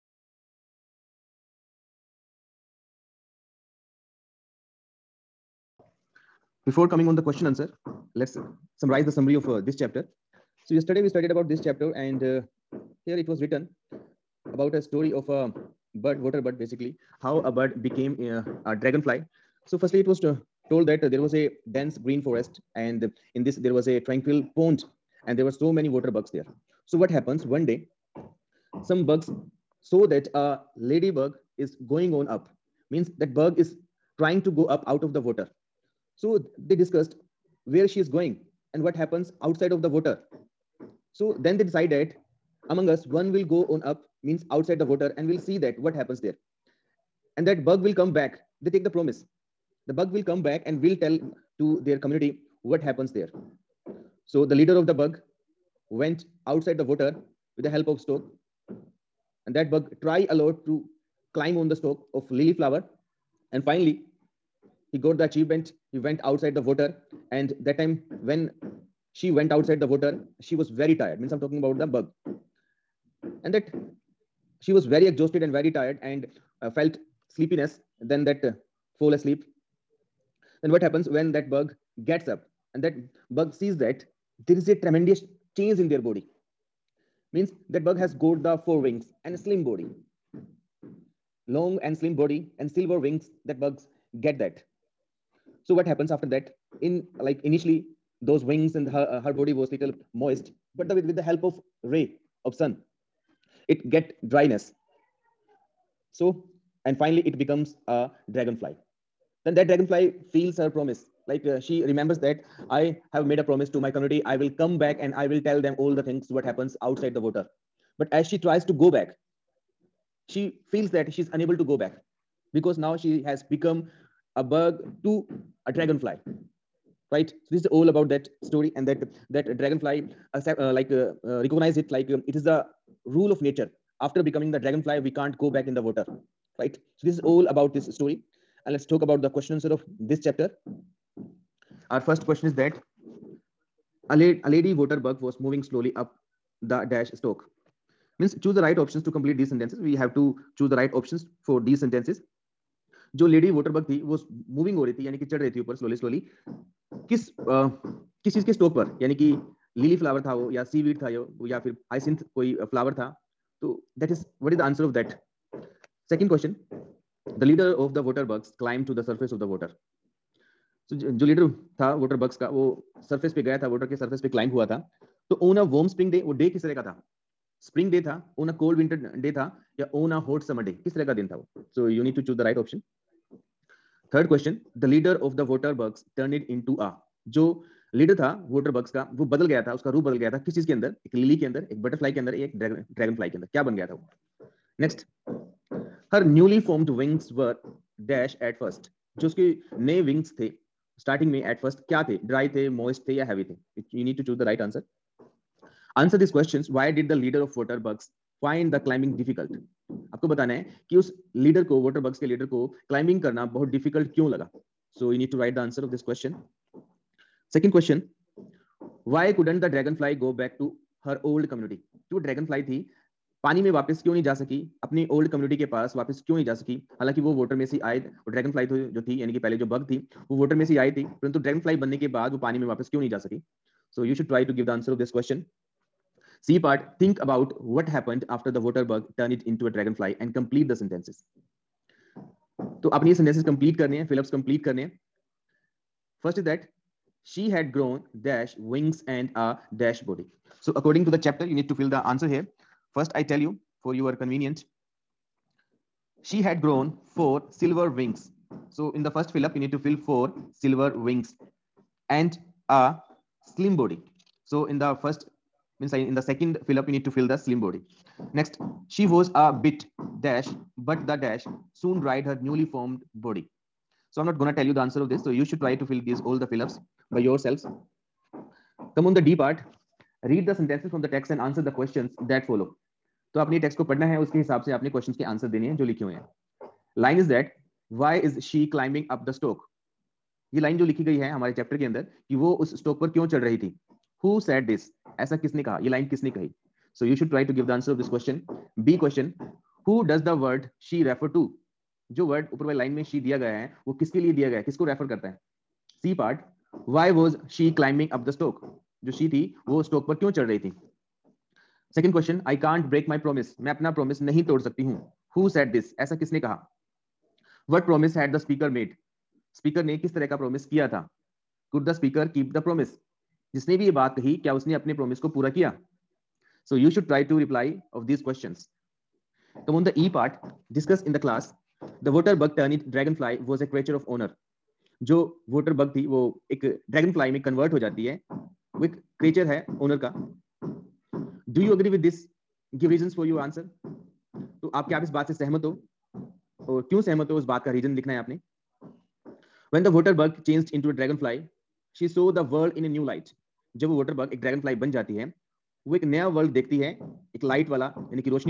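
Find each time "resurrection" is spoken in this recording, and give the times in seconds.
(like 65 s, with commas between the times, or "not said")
not said.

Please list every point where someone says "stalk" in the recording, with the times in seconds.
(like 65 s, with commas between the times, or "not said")
61 s, 147 s.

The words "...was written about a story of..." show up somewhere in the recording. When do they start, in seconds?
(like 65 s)
13 s.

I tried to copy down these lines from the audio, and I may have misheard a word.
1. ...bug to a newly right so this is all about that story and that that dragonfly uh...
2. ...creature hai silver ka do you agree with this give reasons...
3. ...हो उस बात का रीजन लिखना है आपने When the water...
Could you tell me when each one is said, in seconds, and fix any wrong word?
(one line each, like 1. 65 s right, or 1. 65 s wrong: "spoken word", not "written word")
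1. 124 s wrong: "dragonfly", not "newly"
2. 339 s wrong: "owner", not "silver"
3. 347 s right.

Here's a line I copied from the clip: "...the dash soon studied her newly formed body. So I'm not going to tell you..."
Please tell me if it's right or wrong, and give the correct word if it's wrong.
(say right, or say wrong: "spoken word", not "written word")
wrong: "dried", not "studied".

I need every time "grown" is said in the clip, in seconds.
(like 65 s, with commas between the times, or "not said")
247 s, 256 s.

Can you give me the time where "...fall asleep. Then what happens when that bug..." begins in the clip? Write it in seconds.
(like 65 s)
78 s.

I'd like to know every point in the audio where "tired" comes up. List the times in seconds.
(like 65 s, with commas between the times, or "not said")
70 s, 75 s.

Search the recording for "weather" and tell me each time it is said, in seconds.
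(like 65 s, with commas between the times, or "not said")
not said.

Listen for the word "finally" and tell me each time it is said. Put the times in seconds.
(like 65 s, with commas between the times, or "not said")
63 s, 106 s.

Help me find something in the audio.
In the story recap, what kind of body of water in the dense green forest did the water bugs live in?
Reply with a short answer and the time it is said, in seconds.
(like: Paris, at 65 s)
tranquil pond, at 23 s.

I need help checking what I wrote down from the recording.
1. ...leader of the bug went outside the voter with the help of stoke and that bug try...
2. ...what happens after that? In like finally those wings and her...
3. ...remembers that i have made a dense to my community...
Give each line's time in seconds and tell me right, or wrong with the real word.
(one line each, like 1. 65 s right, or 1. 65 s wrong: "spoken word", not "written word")
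1. 54 s right
2. 95 s wrong: "initially", not "finally"
3. 111 s wrong: "promise", not "dense".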